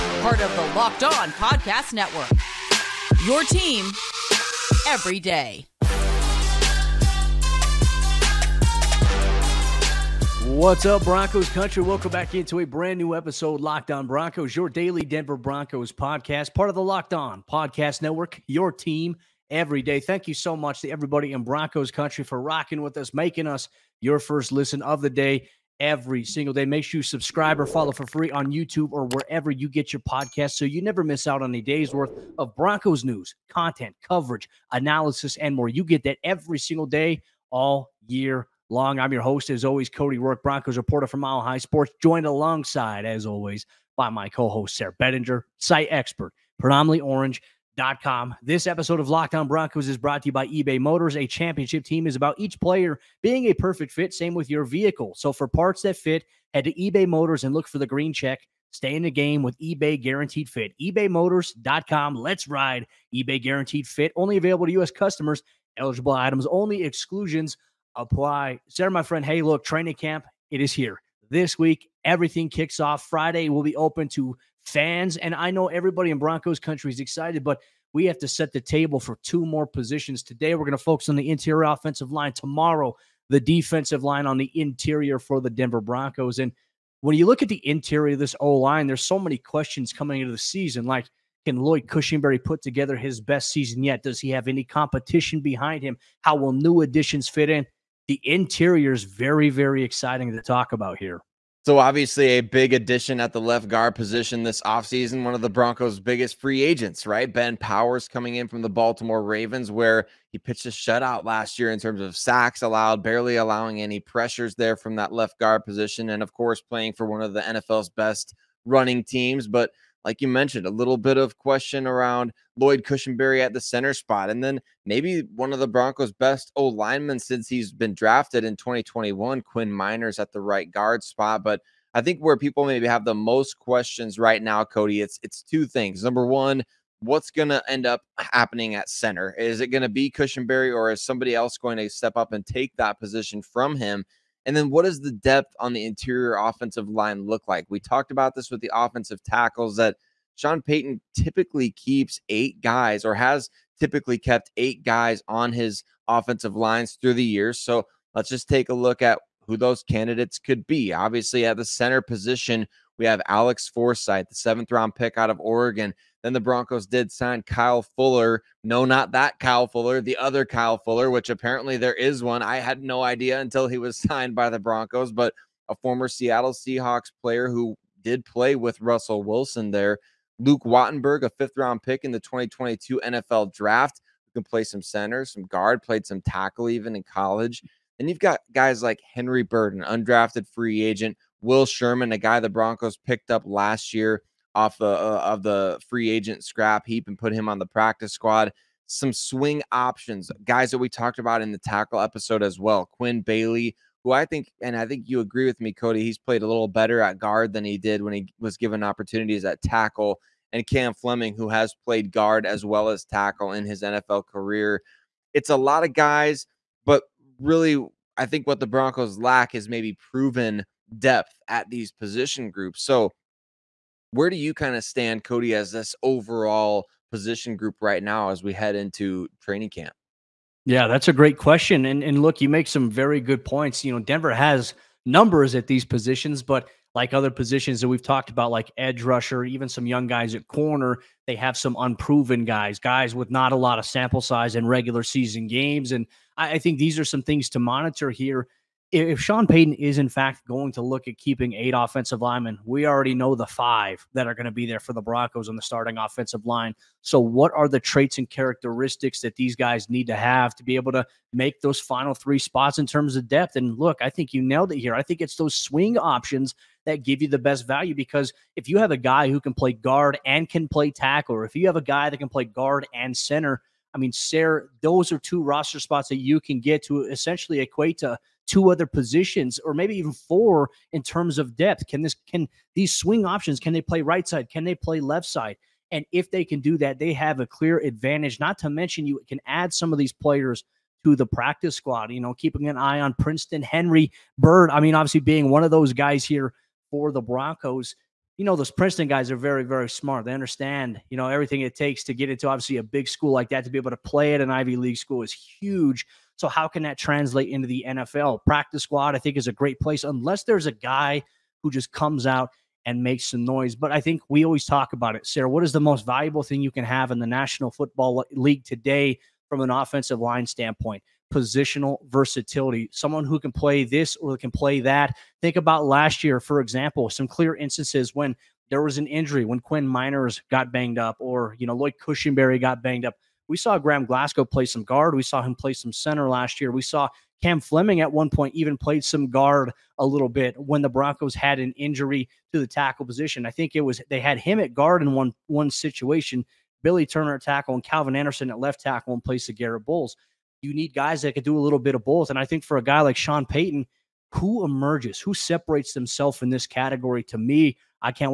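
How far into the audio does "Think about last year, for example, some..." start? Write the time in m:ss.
5:25.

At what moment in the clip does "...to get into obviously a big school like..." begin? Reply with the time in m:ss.
5:02.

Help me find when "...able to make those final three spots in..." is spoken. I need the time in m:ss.
4:20.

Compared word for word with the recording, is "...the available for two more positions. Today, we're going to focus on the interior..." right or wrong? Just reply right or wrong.
wrong.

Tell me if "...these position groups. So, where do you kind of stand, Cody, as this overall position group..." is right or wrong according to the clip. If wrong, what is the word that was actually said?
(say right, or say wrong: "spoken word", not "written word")
right.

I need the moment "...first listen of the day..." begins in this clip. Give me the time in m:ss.
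0:24.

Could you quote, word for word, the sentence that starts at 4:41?
Can this can these swing options can they play right side?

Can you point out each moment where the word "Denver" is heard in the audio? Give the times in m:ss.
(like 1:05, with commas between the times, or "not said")
0:15, 1:25, 3:53.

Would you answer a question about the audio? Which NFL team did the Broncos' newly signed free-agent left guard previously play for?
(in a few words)
Baltimore Ravens.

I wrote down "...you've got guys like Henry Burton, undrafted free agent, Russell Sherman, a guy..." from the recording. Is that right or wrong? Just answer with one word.
wrong.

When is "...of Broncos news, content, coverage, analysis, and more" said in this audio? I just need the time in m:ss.
0:32.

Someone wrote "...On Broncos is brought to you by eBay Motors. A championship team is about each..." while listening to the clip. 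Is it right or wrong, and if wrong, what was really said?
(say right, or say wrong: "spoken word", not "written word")
right.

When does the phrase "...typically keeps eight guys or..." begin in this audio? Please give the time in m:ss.
2:31.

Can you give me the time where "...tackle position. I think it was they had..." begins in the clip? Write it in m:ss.
5:42.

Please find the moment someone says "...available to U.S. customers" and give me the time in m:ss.
1:04.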